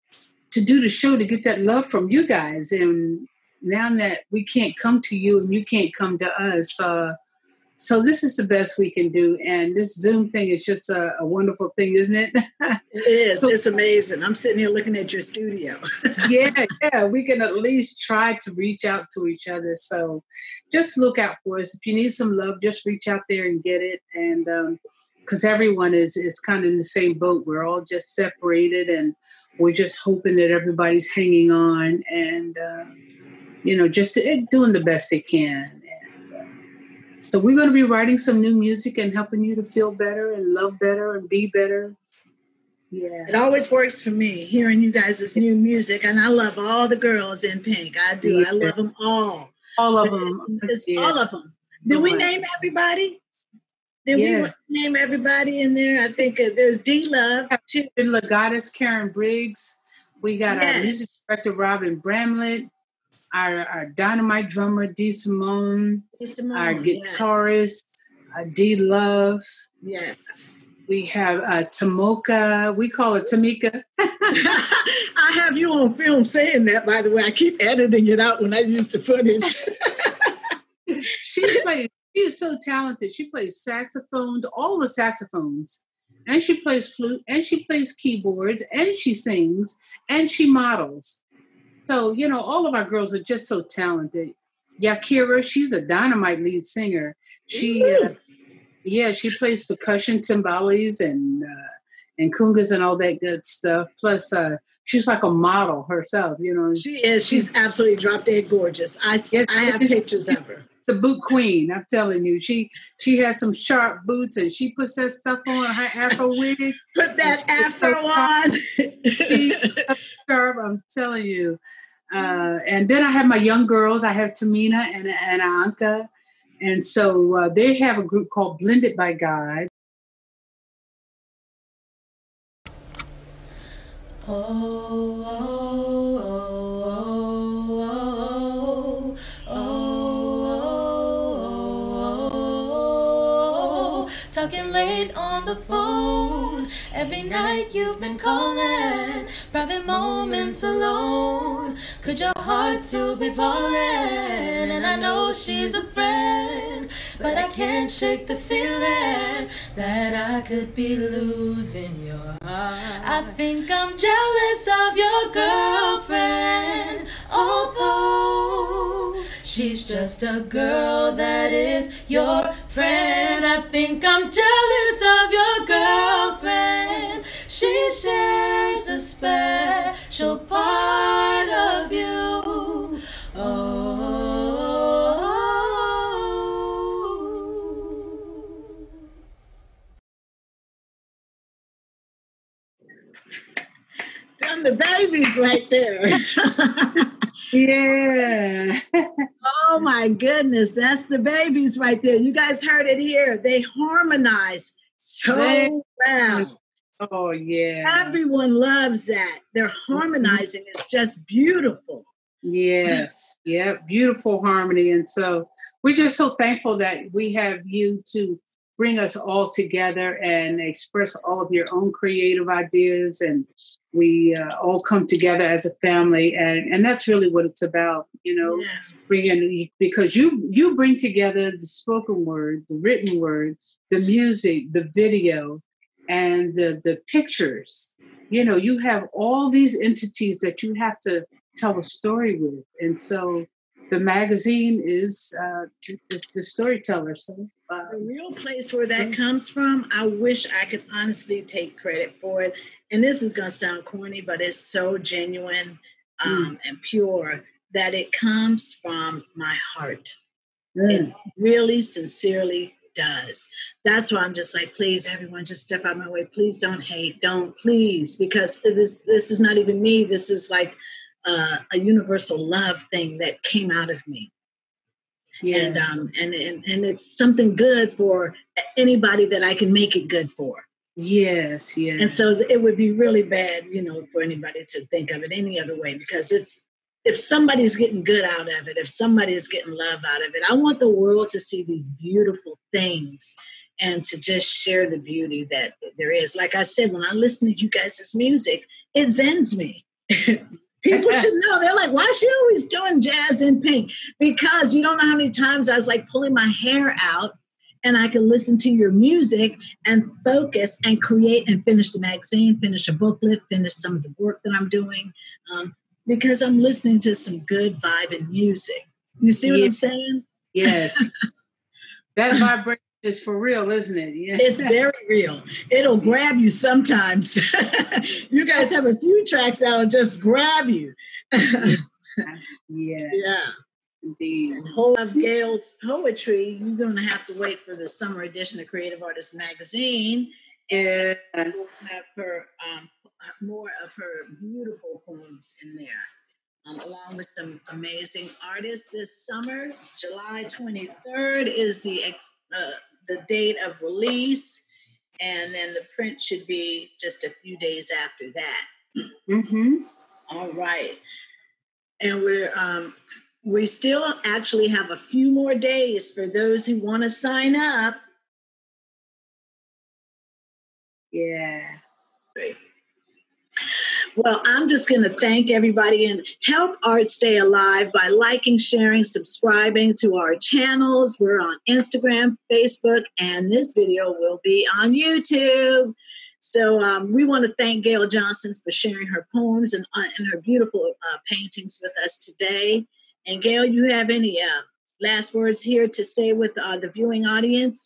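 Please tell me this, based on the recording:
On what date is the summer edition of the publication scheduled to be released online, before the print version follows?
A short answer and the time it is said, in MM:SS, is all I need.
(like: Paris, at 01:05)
July 23, at 05:49.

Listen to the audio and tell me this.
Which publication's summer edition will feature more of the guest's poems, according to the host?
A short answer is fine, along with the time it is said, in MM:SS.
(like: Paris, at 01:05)
Creative Artists Magazine, at 05:38.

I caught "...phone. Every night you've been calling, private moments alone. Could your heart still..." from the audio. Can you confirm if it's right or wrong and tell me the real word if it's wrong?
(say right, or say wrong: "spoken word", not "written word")
right.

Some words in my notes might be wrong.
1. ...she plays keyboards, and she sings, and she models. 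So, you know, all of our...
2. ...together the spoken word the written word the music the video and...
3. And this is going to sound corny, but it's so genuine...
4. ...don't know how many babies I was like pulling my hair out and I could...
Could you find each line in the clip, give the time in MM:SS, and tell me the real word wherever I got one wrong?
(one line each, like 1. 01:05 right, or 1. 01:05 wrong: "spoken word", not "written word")
1. 01:27 right
2. 03:50 right
3. 04:12 right
4. 05:04 wrong: "times", not "babies".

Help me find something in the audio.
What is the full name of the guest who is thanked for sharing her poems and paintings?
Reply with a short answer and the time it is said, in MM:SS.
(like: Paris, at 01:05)
Gail Jhonson, at 06:27.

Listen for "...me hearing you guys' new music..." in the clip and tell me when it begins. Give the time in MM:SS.
00:44.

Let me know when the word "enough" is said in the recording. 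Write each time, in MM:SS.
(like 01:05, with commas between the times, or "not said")
not said.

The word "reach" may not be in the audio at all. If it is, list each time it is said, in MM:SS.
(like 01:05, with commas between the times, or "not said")
00:18, 00:22.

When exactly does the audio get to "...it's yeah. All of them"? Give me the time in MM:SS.
00:50.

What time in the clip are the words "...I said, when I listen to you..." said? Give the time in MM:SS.
04:56.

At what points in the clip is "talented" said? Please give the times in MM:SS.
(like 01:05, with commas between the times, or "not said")
01:22, 01:33.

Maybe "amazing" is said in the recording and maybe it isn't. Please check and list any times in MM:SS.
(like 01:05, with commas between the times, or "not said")
00:13, 05:47.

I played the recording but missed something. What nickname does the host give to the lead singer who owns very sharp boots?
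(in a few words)
the boot queen.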